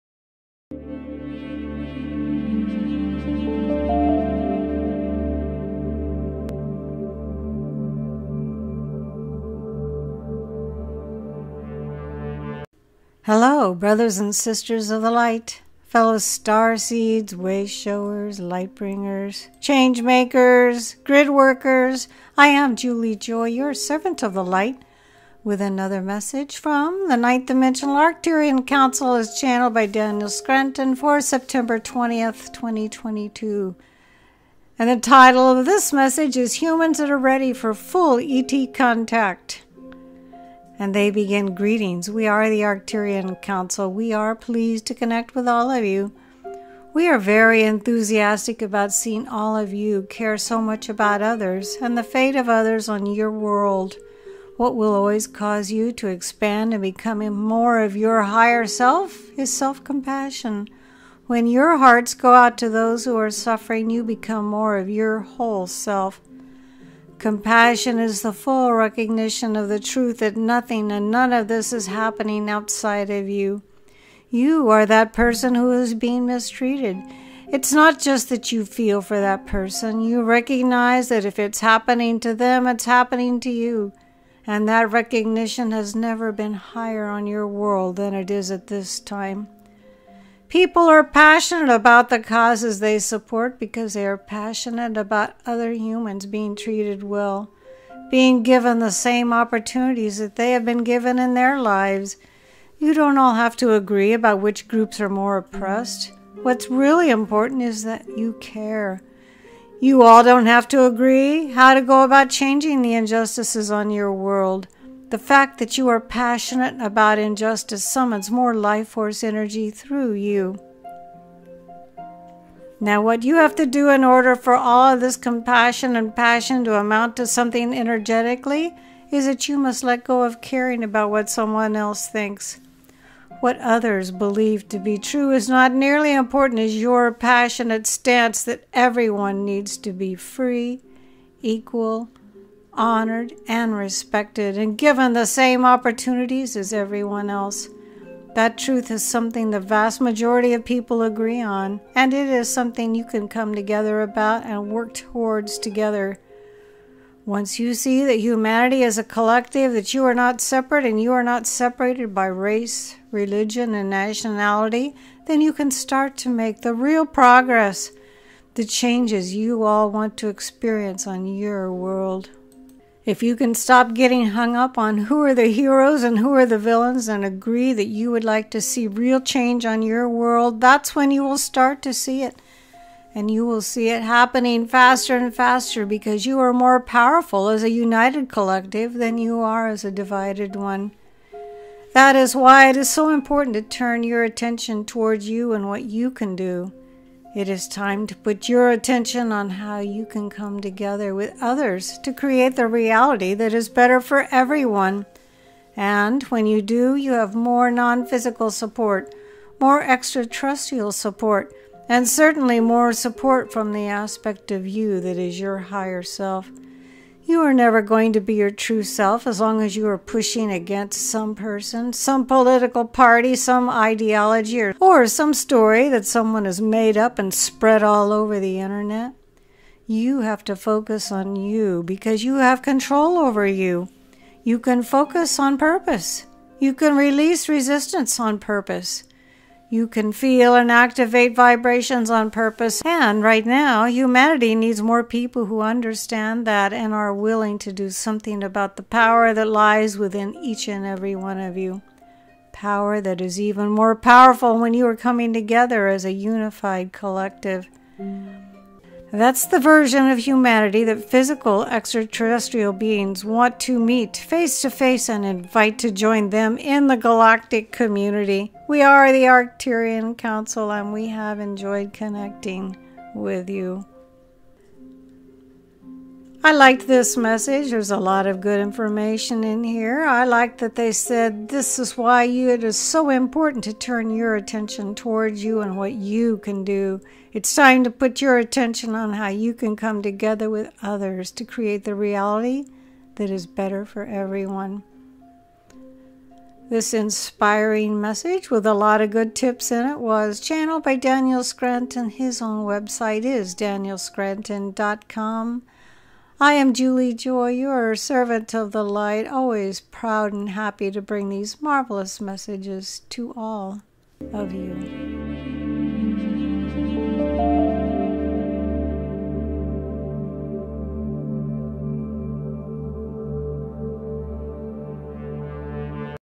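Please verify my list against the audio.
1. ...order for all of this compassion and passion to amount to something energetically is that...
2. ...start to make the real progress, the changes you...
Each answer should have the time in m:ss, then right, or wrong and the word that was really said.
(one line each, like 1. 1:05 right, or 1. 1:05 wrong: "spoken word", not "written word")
1. 2:04 right
2. 2:45 right.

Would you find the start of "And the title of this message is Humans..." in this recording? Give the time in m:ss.
0:34.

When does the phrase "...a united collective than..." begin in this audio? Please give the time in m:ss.
3:07.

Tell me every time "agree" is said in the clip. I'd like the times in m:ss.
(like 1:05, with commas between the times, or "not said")
1:43, 1:50, 2:31, 2:57.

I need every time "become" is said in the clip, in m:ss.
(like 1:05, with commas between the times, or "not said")
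0:56, 1:04.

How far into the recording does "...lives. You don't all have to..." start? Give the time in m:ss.
1:41.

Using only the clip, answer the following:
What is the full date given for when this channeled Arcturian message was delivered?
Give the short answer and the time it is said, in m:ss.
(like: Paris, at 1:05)
September 20th, 2022, at 0:31.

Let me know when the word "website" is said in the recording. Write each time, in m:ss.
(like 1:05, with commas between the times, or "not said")
5:02.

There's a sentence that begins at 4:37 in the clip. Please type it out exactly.
There's a lot of good information in here.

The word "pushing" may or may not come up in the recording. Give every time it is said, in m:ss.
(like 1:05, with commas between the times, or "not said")
3:39.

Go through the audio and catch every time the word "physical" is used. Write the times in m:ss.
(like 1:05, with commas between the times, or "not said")
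3:28, 4:21.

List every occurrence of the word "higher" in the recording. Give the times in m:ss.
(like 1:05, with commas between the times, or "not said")
0:58, 1:26, 3:35.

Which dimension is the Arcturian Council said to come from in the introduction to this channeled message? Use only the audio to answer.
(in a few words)
Ninth.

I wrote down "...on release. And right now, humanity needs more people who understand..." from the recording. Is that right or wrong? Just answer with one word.
wrong.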